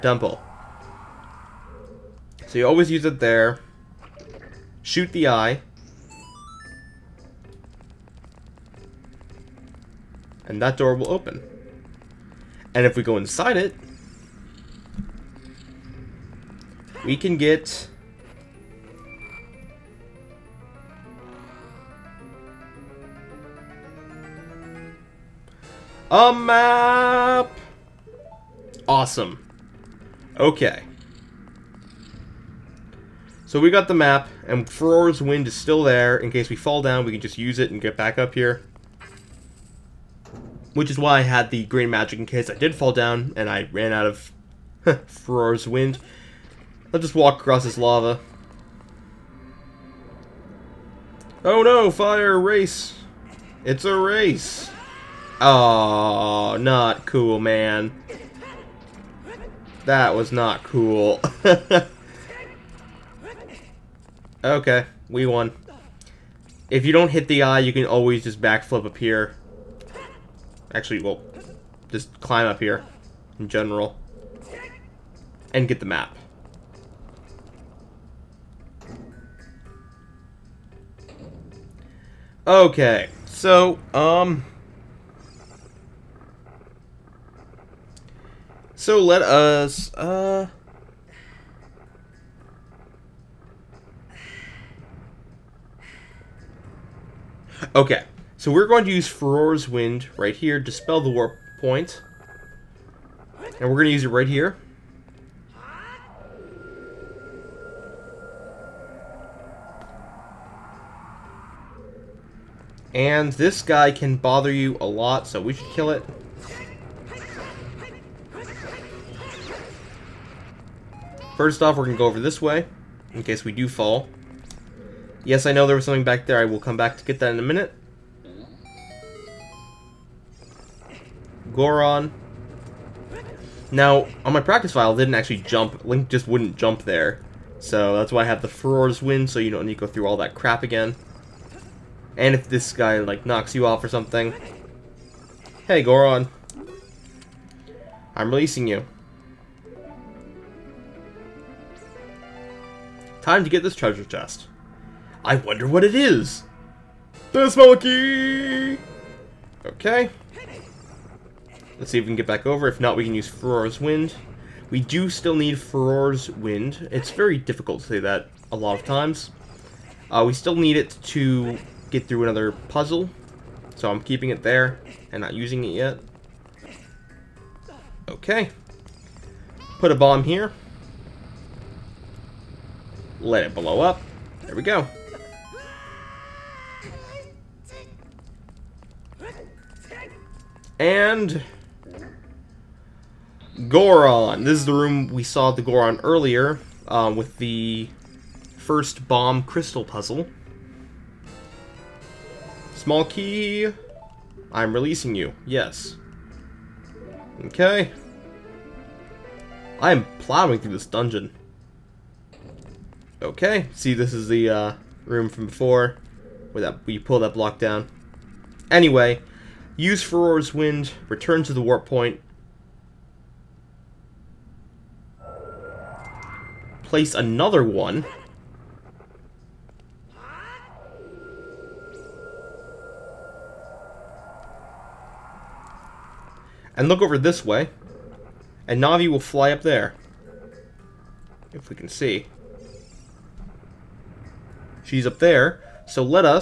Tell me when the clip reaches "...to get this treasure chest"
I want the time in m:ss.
2:33.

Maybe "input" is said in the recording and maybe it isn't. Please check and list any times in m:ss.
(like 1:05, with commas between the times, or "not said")
not said.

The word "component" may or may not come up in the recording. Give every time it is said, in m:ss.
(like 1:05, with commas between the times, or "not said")
not said.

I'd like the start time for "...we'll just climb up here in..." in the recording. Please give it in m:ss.
1:11.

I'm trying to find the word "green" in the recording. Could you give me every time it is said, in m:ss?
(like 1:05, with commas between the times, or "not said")
0:41.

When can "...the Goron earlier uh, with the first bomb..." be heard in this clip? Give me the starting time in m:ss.
3:15.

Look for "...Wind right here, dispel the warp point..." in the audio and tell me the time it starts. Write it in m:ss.
1:39.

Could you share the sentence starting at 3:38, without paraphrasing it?
Anyway, use Farore's Wind, return to the warp point, place another one.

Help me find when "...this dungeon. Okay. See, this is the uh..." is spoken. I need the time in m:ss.
3:30.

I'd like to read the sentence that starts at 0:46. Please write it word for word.
I'll just walk across this lava.